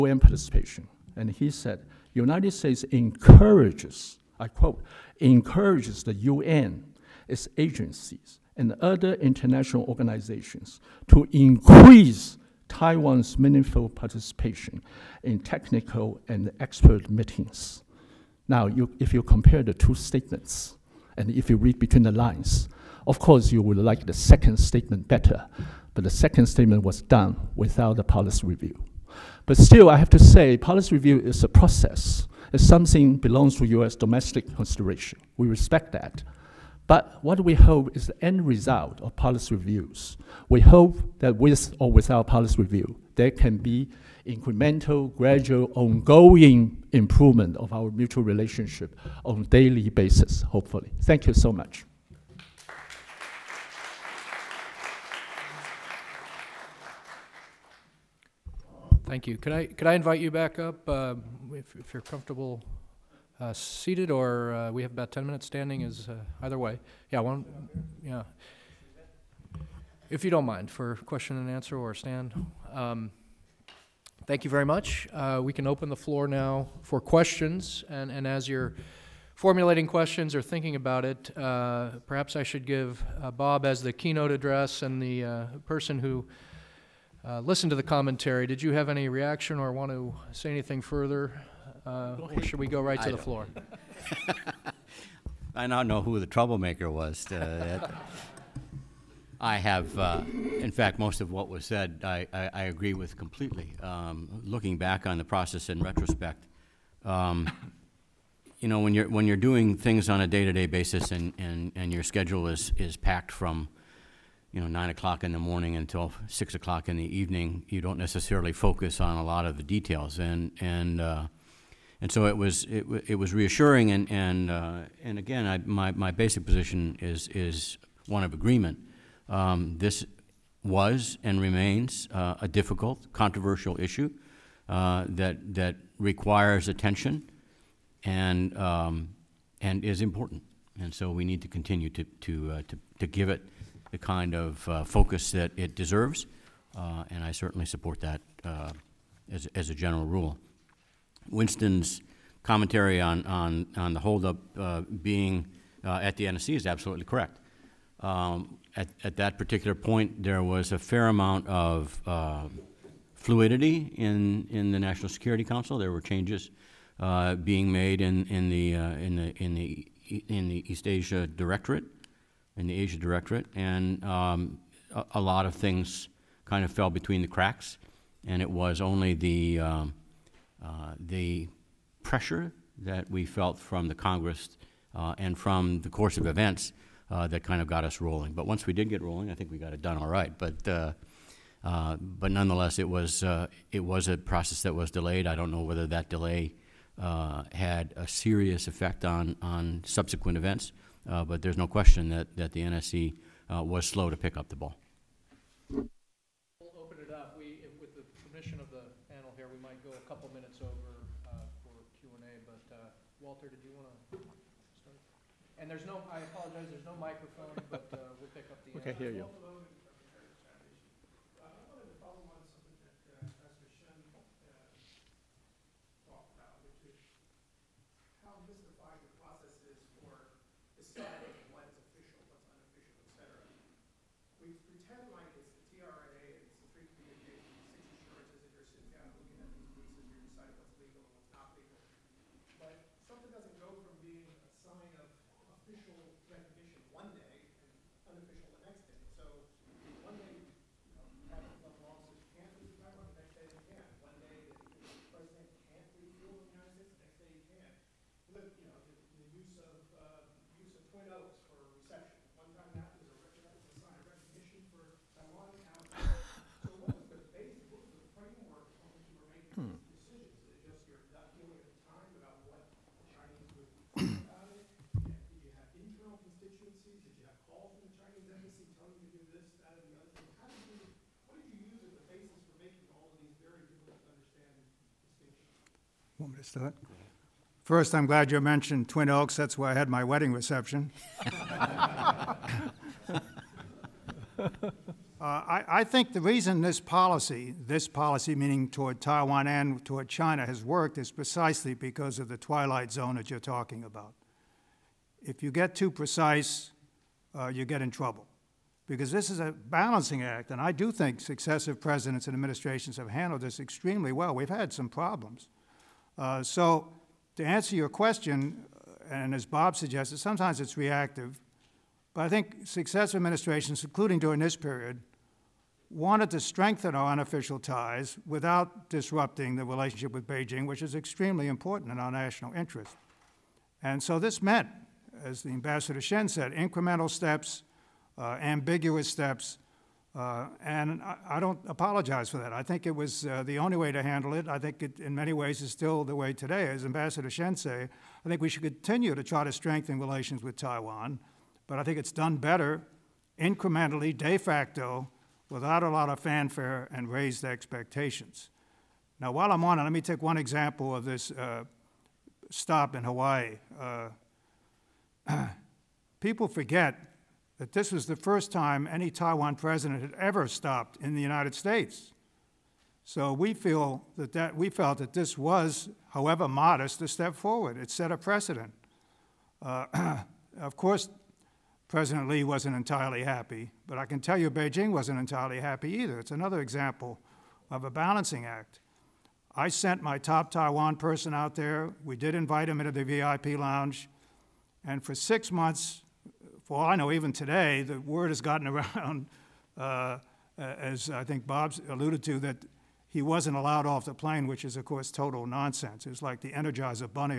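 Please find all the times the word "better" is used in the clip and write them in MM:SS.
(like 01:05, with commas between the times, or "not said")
00:25, 05:52.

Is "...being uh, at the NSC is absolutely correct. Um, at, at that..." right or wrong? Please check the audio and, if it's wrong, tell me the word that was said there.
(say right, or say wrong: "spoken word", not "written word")
right.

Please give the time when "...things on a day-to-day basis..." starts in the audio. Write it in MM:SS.
01:49.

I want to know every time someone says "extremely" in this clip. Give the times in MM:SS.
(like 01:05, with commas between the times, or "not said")
05:13, 05:30.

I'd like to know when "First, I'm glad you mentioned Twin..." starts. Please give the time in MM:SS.
04:47.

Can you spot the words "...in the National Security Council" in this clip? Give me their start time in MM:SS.
02:44.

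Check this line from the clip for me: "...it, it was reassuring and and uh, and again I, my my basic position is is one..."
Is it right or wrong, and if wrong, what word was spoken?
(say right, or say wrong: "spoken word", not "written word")
right.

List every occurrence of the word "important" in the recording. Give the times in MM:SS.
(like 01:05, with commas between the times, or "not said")
02:20, 05:31.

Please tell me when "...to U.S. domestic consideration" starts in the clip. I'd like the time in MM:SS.
00:33.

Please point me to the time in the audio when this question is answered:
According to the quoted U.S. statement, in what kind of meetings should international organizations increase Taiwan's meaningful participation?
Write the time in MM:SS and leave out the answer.
00:15.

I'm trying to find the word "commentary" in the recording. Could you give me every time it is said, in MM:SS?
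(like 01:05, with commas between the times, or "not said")
01:27, 02:32.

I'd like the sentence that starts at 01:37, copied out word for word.
uh, I have, uh, in fact, most of what was said, I, I, I agree with completely.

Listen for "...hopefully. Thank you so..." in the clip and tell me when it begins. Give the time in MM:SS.
00:50.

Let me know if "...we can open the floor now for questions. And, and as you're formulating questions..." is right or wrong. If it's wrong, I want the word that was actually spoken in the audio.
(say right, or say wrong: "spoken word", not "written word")
right.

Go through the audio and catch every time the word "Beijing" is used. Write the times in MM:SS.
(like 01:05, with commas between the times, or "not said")
05:30, 06:24.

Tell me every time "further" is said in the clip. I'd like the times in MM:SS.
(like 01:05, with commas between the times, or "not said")
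01:30.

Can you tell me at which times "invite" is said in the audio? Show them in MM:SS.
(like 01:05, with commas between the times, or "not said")
00:59, 06:32.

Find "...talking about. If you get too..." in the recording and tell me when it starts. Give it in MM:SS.
05:03.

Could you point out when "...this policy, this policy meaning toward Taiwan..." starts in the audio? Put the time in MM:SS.
04:56.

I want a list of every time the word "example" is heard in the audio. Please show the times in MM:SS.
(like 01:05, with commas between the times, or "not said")
06:00, 06:26.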